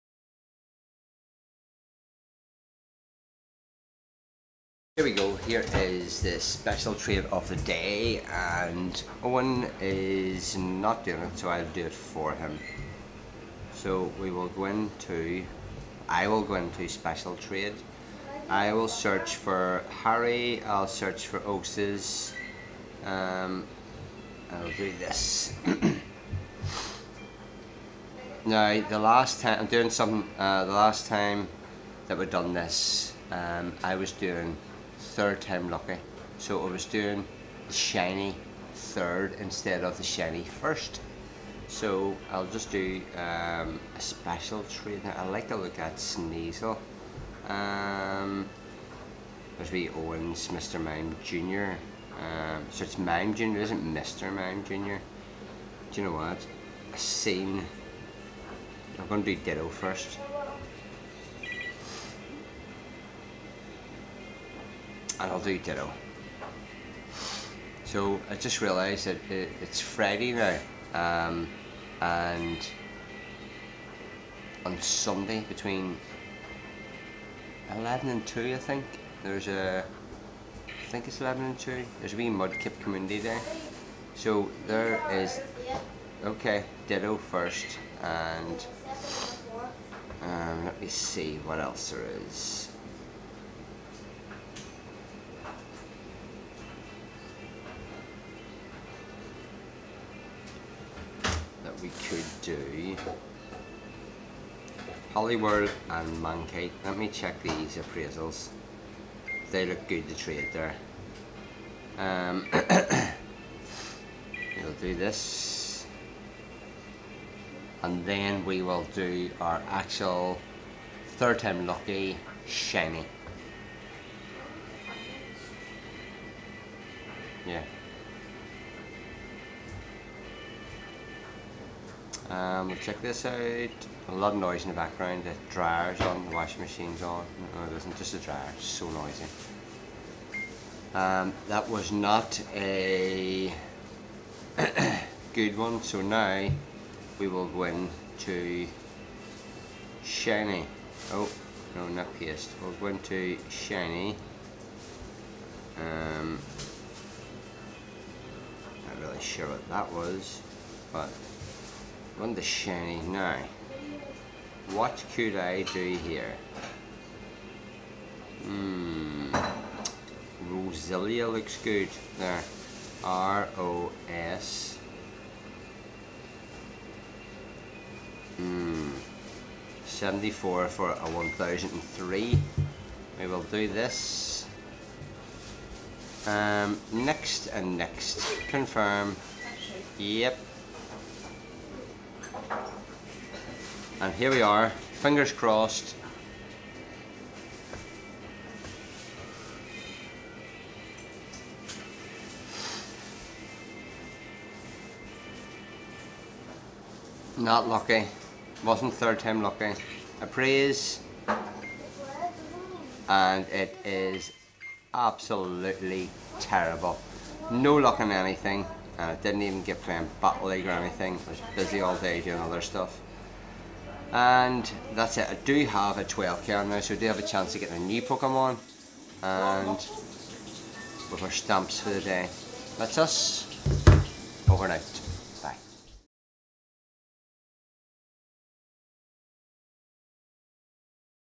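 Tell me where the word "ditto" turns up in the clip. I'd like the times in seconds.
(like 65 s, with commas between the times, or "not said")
59 s, 65 s, 86 s.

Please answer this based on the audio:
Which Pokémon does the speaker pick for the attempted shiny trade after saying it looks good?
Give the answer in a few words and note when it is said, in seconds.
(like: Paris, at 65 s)
Roselia, at 170 s.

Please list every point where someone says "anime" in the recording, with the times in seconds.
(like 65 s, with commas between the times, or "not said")
not said.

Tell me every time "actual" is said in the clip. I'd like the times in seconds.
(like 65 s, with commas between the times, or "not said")
119 s.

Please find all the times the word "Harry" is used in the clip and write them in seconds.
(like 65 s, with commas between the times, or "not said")
19 s.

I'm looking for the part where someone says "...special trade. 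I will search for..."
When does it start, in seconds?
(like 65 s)
16 s.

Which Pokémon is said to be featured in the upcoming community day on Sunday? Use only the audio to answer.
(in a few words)
Mudkip.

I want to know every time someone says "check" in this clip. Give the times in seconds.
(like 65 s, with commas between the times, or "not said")
107 s, 132 s.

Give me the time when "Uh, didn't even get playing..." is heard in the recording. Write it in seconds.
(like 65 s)
218 s.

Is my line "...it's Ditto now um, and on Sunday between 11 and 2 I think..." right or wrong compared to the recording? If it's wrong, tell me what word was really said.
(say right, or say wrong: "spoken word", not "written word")
wrong: "Friday", not "Ditto".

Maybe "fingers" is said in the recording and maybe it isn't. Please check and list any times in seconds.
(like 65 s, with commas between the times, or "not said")
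194 s.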